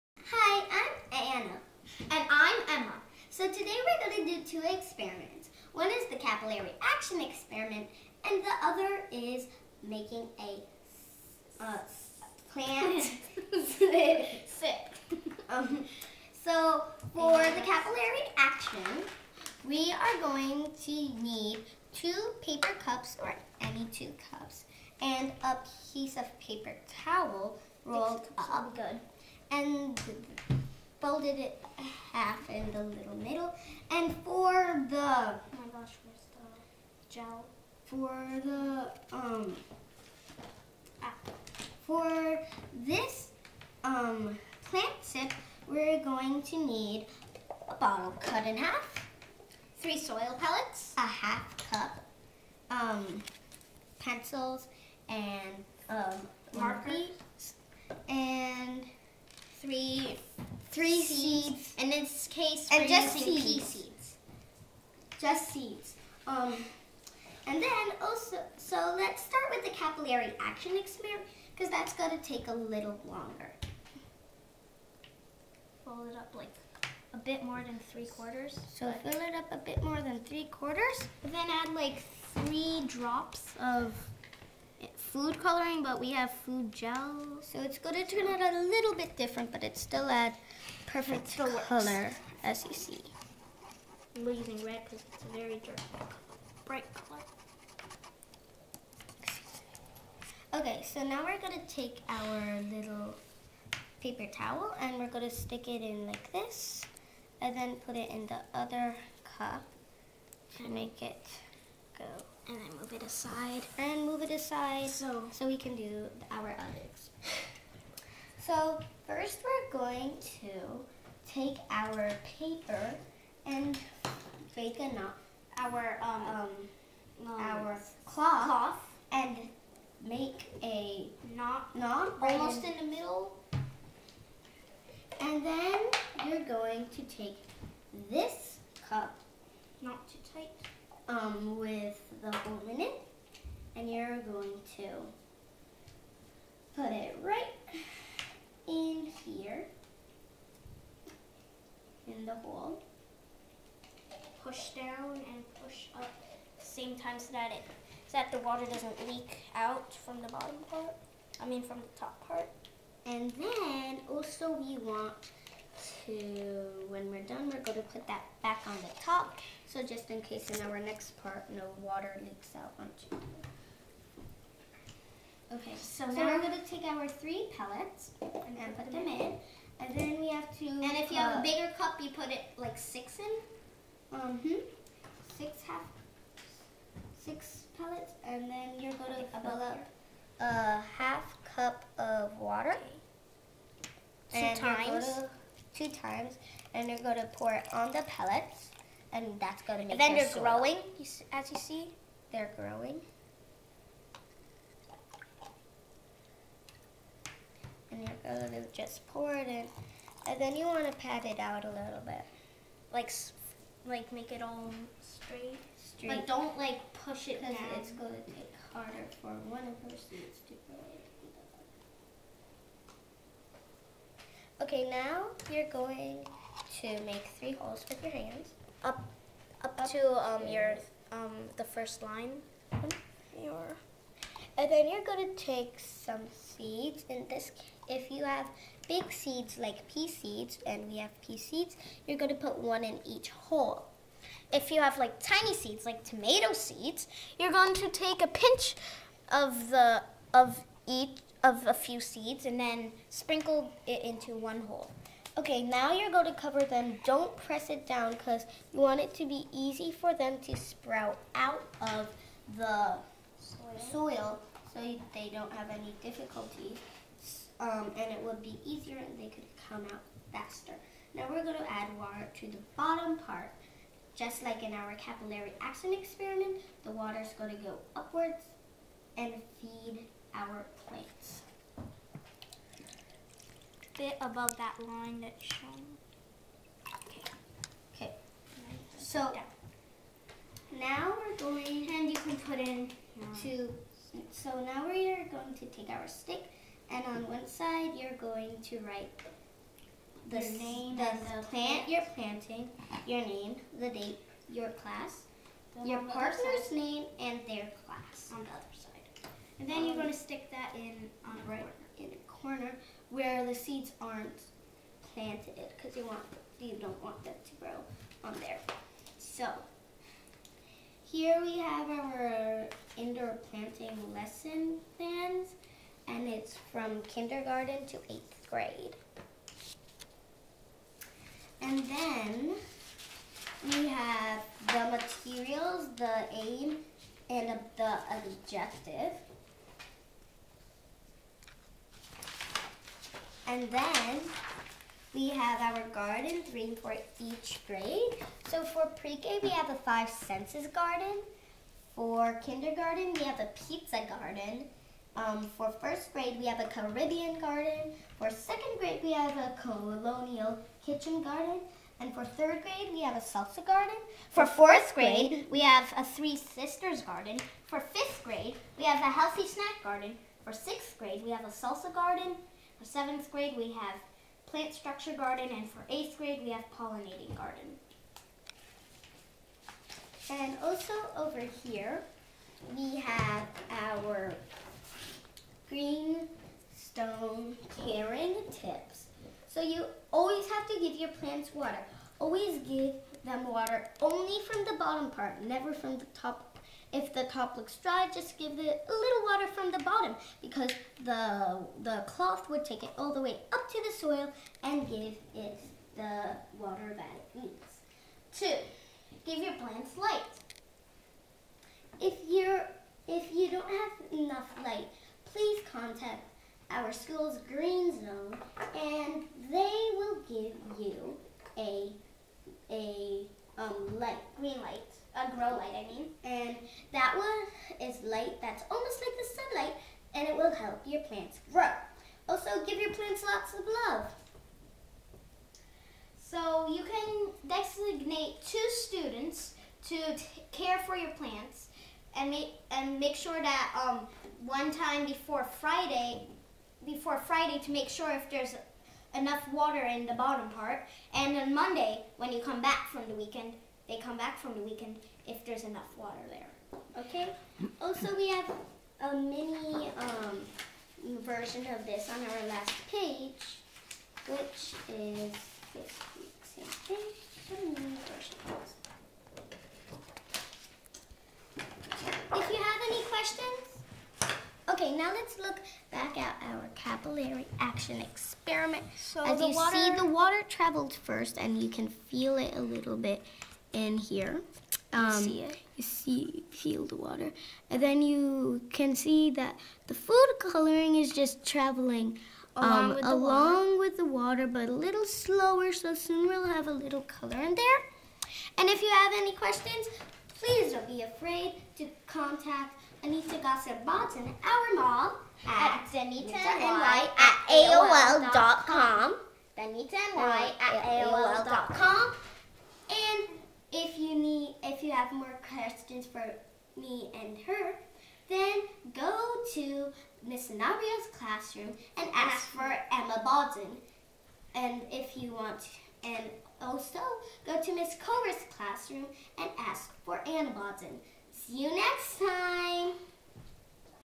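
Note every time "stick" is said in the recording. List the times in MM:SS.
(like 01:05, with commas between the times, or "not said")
01:45, 04:56, 05:10.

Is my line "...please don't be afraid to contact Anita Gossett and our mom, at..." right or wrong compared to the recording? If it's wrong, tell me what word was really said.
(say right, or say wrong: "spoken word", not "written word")
right.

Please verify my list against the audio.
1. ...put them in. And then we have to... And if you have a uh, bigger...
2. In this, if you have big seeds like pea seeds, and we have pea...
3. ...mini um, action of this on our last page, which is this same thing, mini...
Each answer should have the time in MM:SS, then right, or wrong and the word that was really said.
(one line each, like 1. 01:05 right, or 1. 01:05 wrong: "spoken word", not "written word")
1. 02:58 right
2. 03:57 right
3. 07:39 wrong: "version", not "action".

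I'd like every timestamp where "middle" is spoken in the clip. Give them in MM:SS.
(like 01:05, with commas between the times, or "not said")
00:33, 02:12.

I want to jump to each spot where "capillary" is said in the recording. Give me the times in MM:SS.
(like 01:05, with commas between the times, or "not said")
00:06, 00:17, 01:09, 04:34, 07:56.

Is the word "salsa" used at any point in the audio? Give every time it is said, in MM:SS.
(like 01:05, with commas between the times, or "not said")
06:03, 06:11.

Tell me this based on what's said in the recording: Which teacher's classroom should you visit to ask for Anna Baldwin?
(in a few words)
Miss Cora.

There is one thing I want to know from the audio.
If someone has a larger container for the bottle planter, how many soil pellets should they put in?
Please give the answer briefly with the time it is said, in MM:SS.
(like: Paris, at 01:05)
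6, at 03:07.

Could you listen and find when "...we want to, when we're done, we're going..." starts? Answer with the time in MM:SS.
02:44.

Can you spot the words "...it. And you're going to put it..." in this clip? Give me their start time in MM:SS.
02:22.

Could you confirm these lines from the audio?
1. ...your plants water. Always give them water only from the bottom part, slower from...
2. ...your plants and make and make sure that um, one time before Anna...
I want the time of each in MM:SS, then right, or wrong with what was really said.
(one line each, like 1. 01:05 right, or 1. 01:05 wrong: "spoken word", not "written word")
1. 06:30 wrong: "never", not "slower"
2. 07:20 wrong: "Friday", not "Anna".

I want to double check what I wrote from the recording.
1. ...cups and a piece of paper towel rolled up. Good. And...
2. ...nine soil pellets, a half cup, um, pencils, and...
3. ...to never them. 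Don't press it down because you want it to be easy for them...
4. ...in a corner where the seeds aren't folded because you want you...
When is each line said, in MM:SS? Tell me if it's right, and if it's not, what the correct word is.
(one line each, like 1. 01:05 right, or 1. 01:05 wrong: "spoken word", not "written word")
1. 00:24 right
2. 00:49 wrong: "three", not "nine"
3. 04:16 wrong: "cover", not "never"
4. 05:11 wrong: "planted", not "folded".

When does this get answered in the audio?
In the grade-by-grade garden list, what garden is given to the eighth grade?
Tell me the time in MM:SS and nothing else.
06:16.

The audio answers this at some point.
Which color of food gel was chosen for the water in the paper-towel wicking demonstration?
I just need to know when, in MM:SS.
01:34.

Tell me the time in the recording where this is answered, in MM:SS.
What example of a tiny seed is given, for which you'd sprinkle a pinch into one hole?
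04:06.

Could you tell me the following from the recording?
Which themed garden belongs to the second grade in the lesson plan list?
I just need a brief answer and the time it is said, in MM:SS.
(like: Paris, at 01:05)
colonial kitchen garden, at 05:59.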